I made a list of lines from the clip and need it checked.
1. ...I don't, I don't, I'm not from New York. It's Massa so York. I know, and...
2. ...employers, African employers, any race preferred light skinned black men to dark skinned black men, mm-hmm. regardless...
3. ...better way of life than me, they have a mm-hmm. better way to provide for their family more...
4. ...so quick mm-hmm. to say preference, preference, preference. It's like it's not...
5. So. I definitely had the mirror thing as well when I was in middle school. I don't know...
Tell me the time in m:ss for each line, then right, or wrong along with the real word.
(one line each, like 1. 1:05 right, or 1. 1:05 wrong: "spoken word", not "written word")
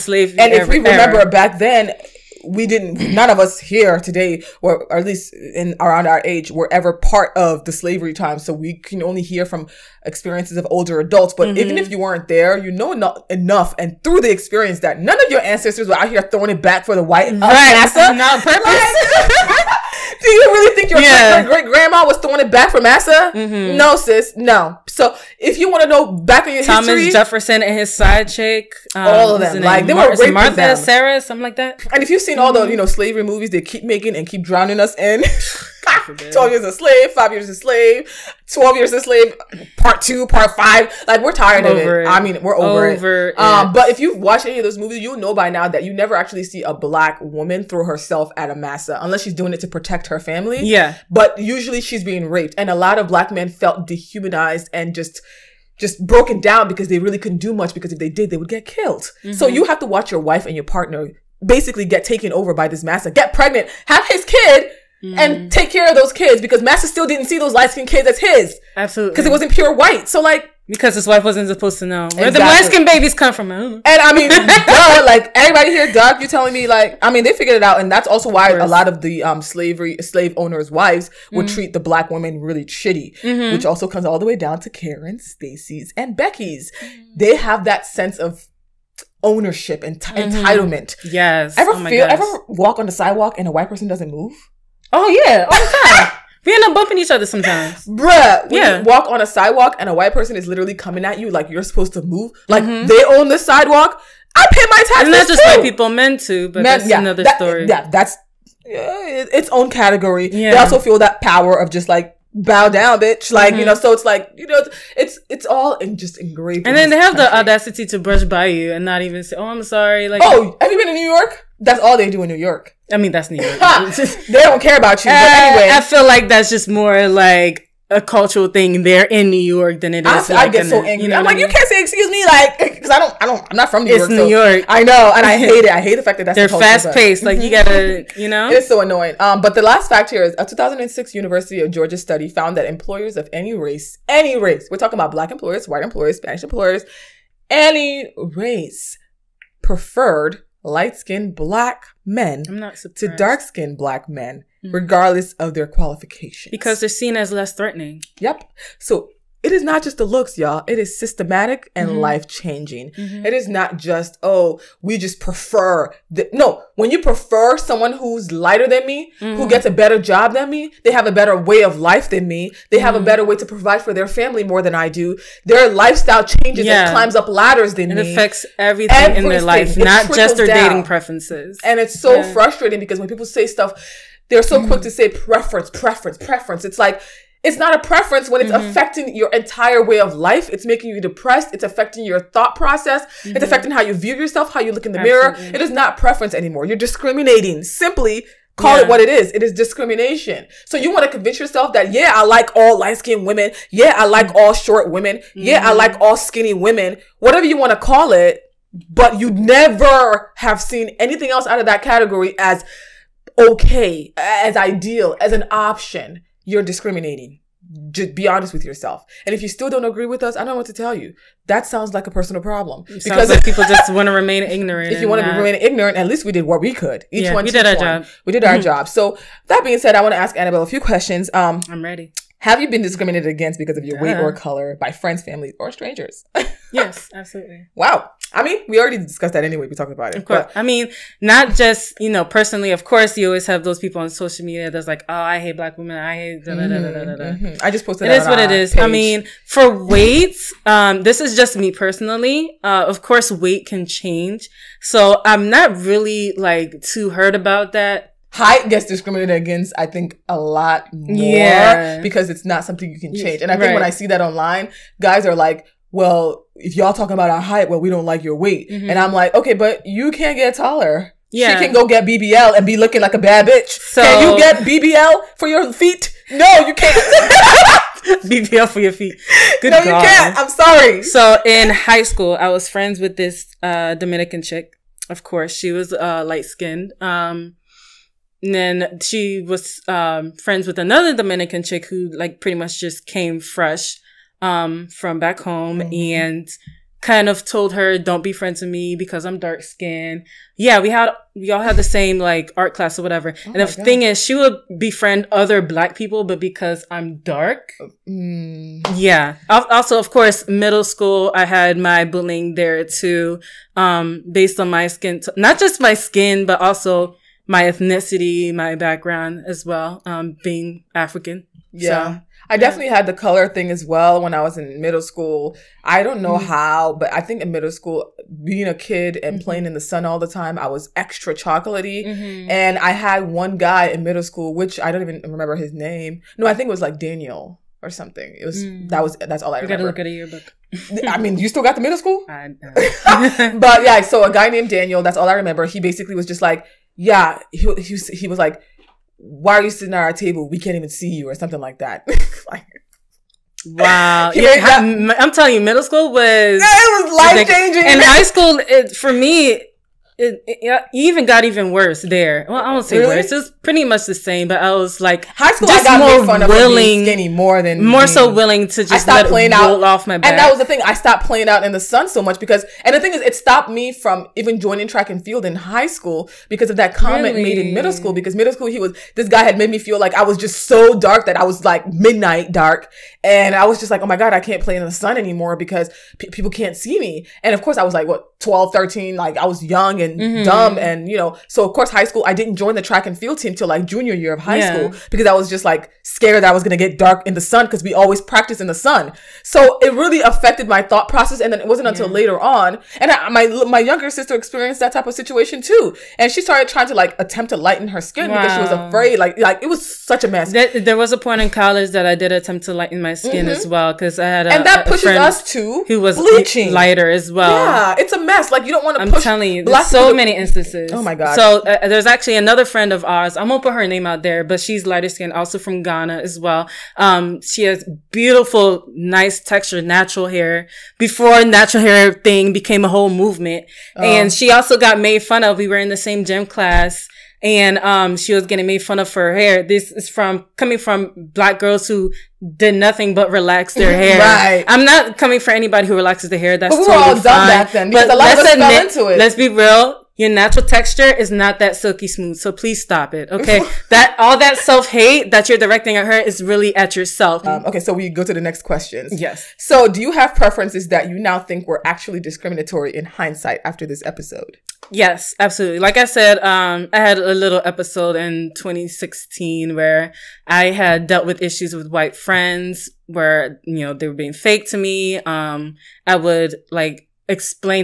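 1. 2:12 wrong: "New", not "Massa"
2. 2:25 wrong: "Spanish", not "African"
3. 2:51 right
4. 3:04 right
5. 5:22 wrong: "color", not "mirror".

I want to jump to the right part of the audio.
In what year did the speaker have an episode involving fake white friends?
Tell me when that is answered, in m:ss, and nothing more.
7:48.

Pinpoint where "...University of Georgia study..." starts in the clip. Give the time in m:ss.
2:21.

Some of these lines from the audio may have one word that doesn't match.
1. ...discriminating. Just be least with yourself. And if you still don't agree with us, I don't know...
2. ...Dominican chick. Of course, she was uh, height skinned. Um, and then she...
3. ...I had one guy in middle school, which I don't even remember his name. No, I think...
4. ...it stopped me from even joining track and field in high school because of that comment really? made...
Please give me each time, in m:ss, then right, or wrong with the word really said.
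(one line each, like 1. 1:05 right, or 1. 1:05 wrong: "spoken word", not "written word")
1. 3:36 wrong: "honest", not "least"
2. 4:43 wrong: "light", not "height"
3. 5:32 right
4. 6:13 right.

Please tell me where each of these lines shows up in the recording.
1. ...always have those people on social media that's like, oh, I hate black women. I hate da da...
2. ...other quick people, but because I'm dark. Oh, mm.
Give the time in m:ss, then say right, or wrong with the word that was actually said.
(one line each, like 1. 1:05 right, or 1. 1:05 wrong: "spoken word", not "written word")
1. 4:03 right
2. 5:05 wrong: "black", not "quick".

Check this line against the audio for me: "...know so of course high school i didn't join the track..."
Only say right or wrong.
right.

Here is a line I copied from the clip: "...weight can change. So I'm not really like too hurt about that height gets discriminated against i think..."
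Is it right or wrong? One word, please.
right.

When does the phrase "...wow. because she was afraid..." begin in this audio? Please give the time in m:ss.
6:48.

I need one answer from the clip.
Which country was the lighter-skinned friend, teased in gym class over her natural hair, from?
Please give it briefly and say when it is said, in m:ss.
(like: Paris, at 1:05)
Ghana, at 7:05.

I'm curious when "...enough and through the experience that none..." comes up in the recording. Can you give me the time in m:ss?
0:13.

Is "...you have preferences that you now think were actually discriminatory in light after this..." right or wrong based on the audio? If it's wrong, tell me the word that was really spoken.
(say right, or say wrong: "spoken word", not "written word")
wrong: "hindsight", not "light".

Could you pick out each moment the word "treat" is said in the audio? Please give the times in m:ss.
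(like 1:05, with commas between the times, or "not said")
1:21.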